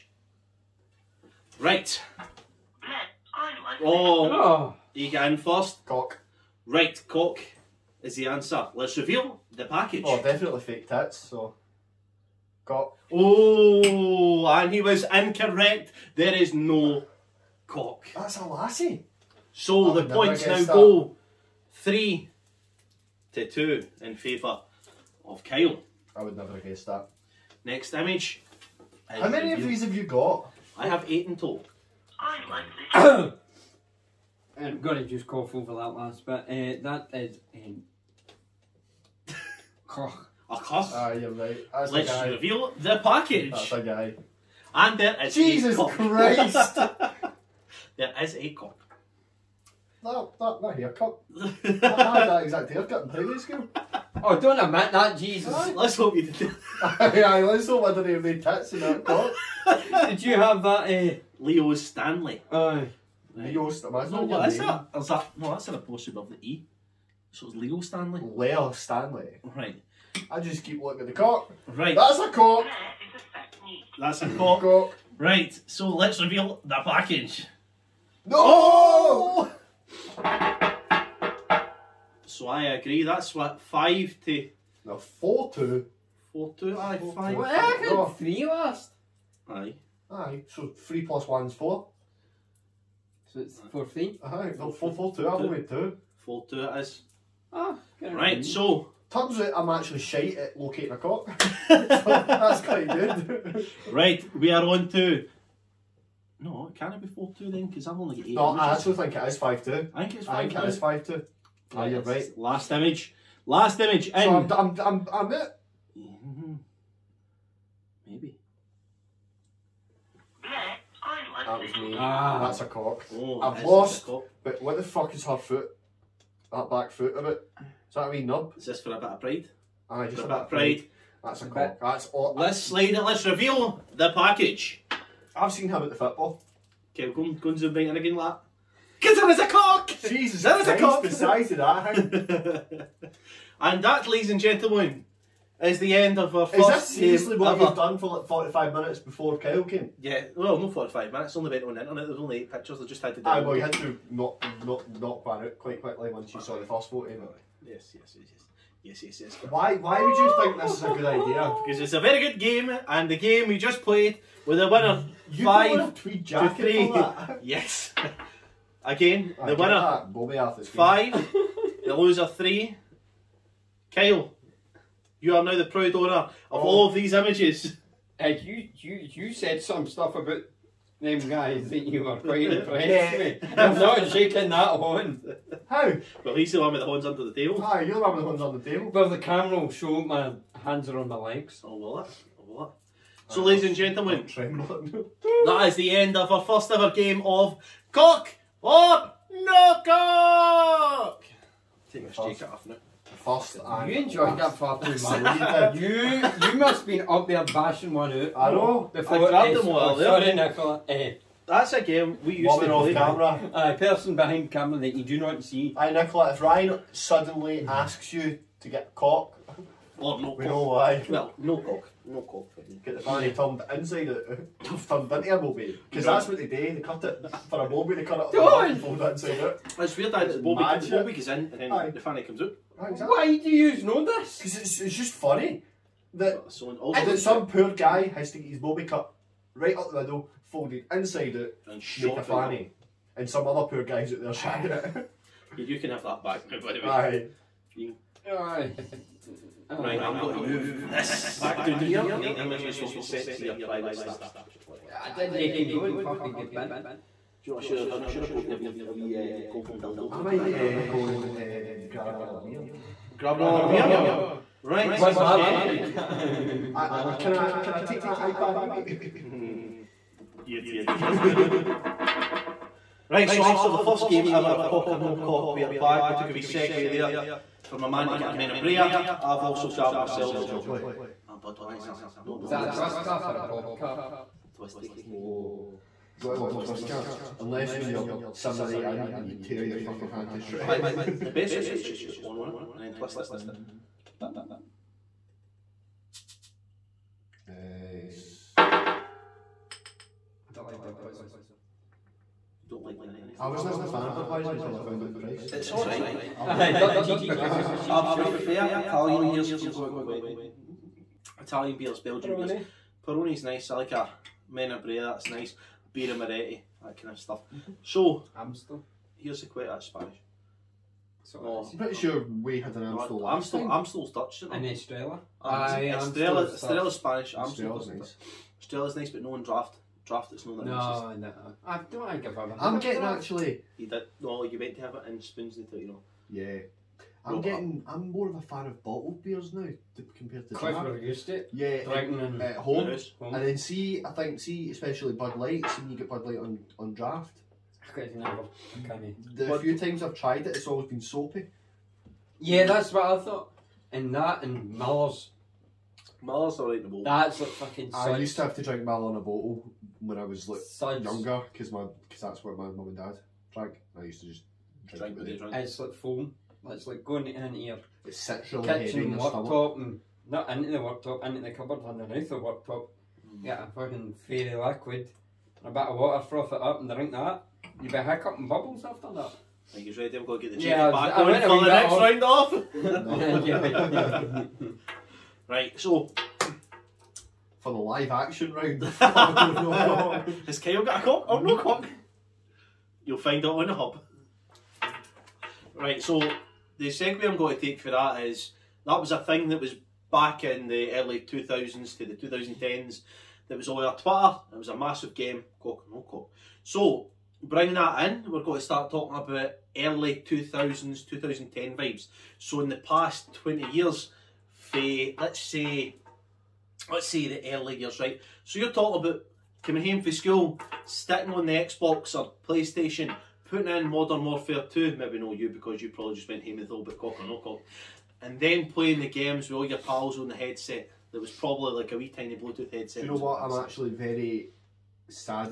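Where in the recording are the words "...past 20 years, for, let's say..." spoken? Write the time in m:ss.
6:52.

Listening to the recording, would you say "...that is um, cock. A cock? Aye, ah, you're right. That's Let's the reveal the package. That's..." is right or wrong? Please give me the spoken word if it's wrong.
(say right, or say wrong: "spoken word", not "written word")
right.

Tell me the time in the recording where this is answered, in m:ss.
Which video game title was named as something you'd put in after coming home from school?
7:03.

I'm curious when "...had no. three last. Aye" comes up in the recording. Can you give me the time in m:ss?
1:27.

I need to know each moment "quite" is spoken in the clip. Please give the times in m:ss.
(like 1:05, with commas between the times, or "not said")
1:42, 2:35, 3:02, 5:40.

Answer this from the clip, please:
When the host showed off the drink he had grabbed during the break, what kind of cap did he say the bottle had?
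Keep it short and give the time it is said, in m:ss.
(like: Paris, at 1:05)
Twisty, at 4:44.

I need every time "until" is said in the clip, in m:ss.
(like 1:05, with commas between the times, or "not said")
5:04, 5:35.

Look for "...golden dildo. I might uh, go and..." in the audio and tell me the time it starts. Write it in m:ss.
4:19.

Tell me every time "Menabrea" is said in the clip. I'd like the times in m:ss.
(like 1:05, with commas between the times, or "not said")
4:38, 5:14.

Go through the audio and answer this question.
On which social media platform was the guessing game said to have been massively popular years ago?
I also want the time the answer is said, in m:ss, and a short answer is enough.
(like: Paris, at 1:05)
Twitter, at 6:43.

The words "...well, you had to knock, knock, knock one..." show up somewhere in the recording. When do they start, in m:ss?
2:33.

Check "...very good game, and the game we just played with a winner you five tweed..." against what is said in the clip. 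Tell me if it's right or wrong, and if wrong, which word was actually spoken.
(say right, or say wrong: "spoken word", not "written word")
right.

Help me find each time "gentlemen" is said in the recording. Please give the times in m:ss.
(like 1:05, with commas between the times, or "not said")
2:24, 3:13.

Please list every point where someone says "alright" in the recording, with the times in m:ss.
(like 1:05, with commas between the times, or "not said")
5:05, 5:56.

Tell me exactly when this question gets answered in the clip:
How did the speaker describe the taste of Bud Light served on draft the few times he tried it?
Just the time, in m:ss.
5:51.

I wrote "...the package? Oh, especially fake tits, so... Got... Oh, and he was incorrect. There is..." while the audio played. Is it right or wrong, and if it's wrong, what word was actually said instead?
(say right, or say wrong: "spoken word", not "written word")
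wrong: "definitely", not "especially".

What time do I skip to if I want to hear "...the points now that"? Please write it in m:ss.
0:20.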